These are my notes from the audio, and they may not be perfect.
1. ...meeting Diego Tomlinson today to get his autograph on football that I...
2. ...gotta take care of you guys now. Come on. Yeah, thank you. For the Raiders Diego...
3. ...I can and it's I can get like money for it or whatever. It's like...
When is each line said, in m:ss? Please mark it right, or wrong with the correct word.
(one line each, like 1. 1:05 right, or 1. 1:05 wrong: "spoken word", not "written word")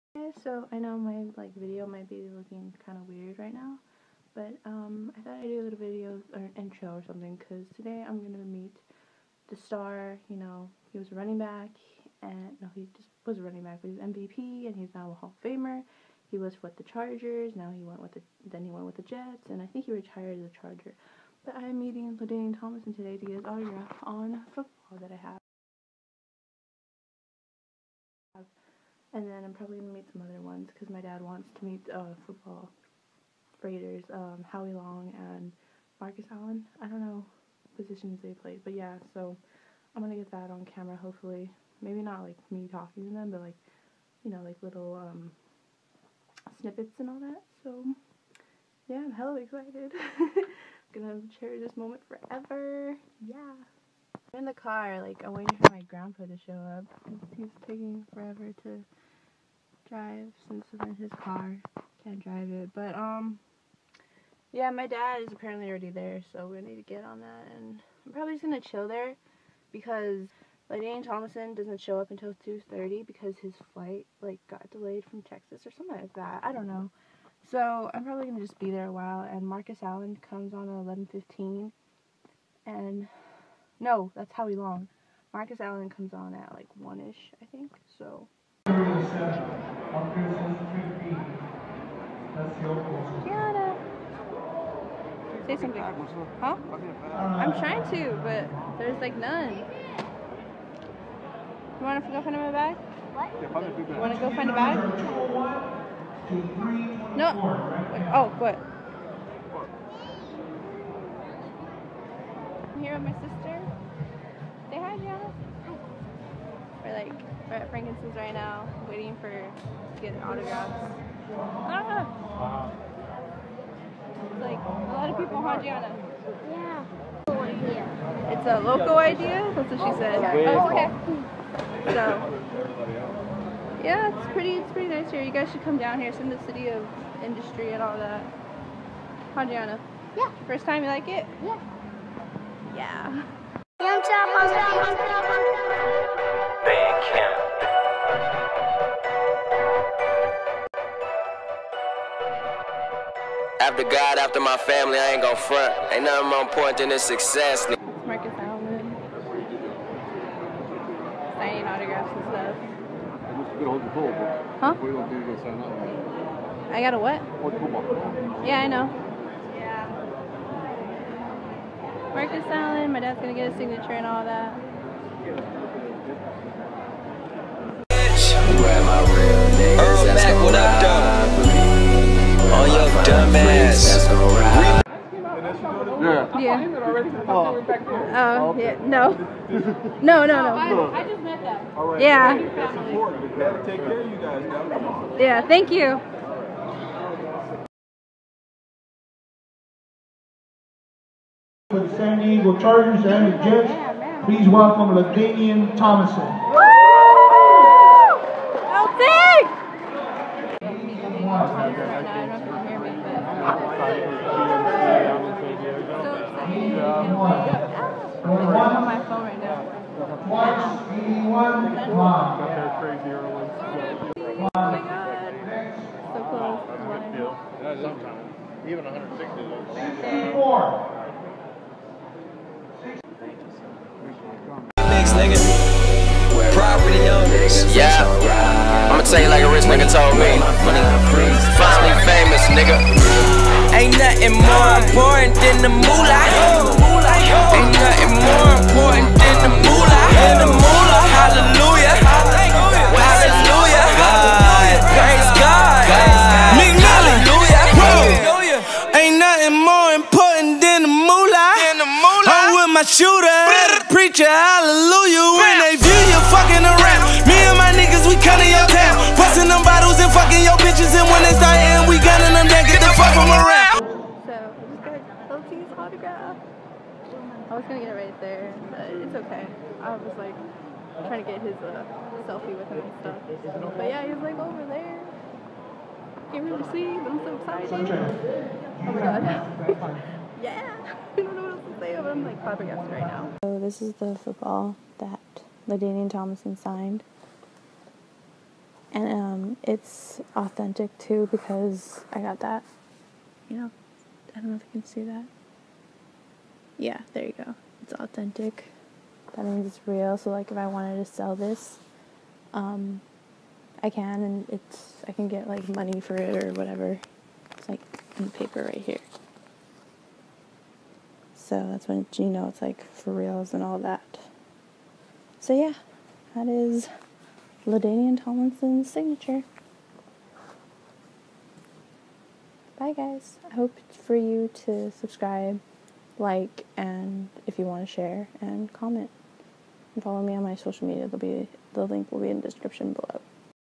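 1. 0:21 wrong: "LaDainian", not "Diego"
2. 3:13 wrong: "San", not "Raiders"
3. 5:13 right.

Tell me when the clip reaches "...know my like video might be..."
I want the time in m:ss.
0:00.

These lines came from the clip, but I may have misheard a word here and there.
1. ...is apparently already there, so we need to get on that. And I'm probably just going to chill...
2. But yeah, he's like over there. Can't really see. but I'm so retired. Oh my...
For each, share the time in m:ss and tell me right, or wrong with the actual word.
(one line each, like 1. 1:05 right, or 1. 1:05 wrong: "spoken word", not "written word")
1. 1:05 right
2. 4:43 wrong: "excited", not "retired".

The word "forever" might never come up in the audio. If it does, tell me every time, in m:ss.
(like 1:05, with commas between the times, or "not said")
0:52, 0:58.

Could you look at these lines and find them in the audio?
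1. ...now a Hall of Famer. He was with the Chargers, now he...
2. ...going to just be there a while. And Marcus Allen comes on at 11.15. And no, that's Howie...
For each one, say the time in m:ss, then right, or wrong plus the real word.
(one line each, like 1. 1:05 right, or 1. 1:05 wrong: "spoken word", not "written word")
1. 0:14 right
2. 1:18 right.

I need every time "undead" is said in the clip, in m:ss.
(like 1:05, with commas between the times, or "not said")
not said.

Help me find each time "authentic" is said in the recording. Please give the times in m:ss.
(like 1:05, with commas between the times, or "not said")
5:00, 5:07.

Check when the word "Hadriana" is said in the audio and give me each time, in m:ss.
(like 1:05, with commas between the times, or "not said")
2:19.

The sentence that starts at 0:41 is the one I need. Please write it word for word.
Maybe not like me talking to them, but like, you know, like little um, snippets and all that.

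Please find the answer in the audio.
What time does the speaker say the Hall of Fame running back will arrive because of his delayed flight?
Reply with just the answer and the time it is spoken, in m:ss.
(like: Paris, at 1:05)
2:30, at 1:12.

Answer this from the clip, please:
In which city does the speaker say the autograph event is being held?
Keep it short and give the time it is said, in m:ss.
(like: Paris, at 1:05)
City of Industry, at 2:16.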